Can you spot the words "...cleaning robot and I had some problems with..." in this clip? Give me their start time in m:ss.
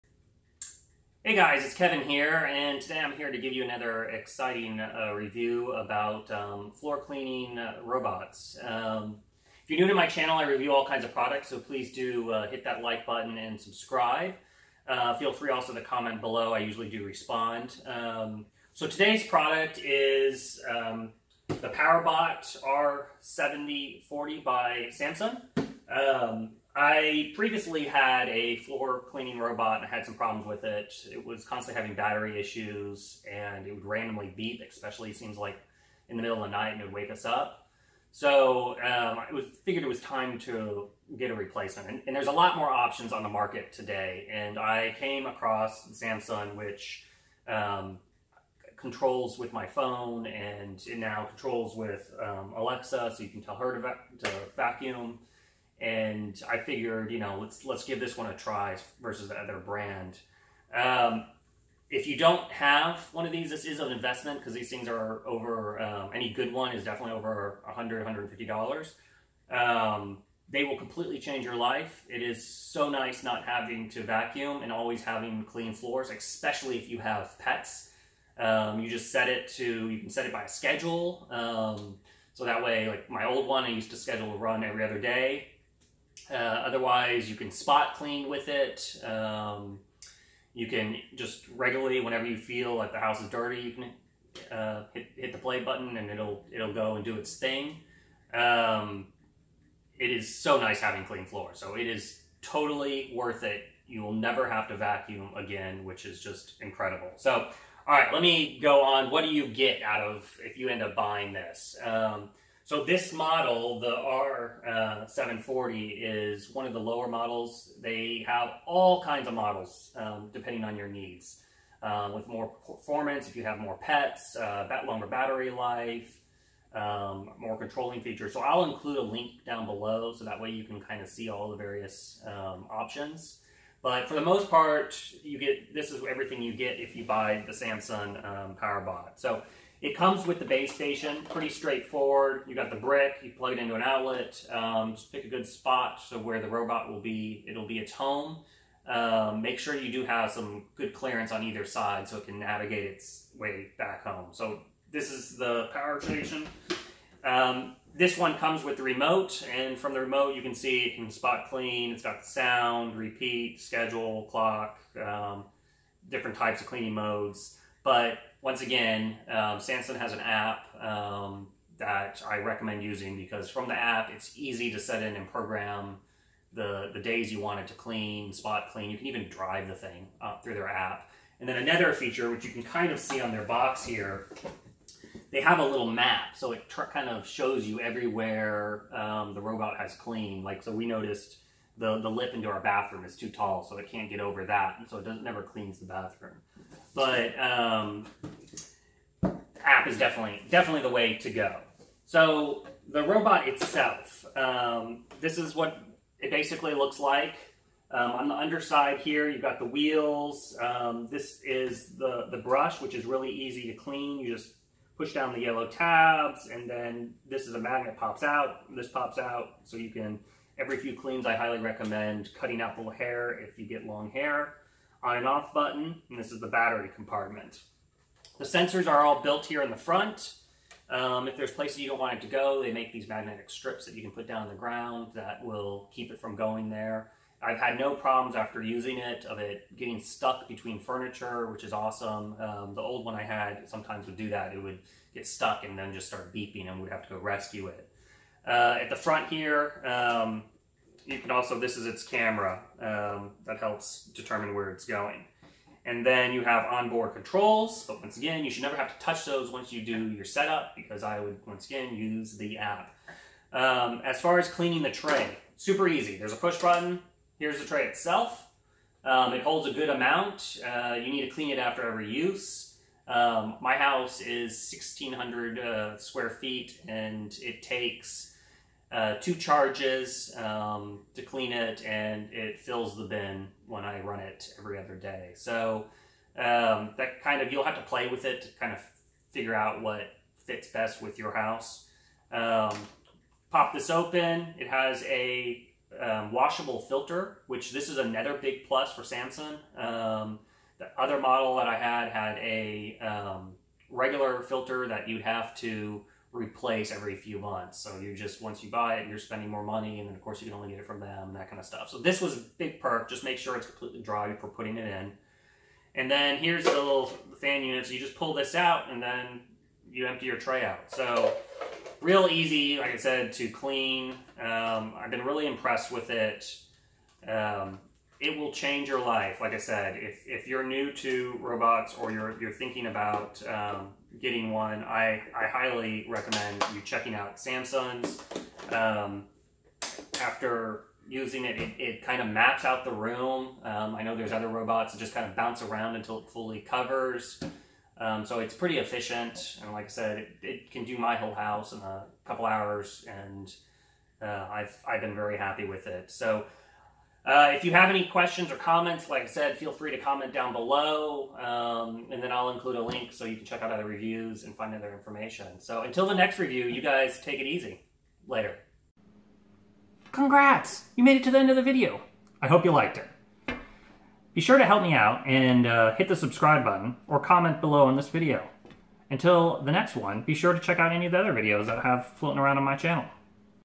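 0:29.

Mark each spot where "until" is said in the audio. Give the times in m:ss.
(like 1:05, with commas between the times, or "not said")
5:45, 6:05, 6:19.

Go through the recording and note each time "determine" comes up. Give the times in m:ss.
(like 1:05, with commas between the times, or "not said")
4:14.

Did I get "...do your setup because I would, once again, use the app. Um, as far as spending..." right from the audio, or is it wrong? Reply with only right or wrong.
wrong.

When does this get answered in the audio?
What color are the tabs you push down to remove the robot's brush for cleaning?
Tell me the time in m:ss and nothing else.
3:35.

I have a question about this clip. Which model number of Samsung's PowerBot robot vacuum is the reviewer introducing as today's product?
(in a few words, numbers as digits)
R7040.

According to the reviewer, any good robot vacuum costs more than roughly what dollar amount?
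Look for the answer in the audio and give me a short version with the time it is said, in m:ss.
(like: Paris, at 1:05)
$150, at 1:08.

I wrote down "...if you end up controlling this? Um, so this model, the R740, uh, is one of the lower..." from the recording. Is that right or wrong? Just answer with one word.
wrong.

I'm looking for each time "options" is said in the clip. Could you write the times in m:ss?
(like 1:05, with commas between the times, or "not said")
0:42, 2:12.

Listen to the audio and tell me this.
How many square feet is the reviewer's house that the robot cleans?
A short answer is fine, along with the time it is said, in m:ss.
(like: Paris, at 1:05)
1,600, at 4:34.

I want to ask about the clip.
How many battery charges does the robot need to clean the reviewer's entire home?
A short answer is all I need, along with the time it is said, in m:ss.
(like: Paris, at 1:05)
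2, at 4:39.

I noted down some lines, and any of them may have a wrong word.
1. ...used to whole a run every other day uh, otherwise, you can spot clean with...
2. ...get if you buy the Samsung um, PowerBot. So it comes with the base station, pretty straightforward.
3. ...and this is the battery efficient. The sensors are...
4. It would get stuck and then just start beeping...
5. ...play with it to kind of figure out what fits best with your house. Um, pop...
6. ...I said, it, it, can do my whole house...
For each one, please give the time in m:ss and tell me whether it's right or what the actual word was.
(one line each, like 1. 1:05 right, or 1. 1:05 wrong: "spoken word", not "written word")
1. 1:23 wrong: "schedule", not "whole"
2. 2:16 right
3. 3:46 wrong: "compartment", not "efficient"
4. 4:04 right
5. 4:47 right
6. 5:49 right.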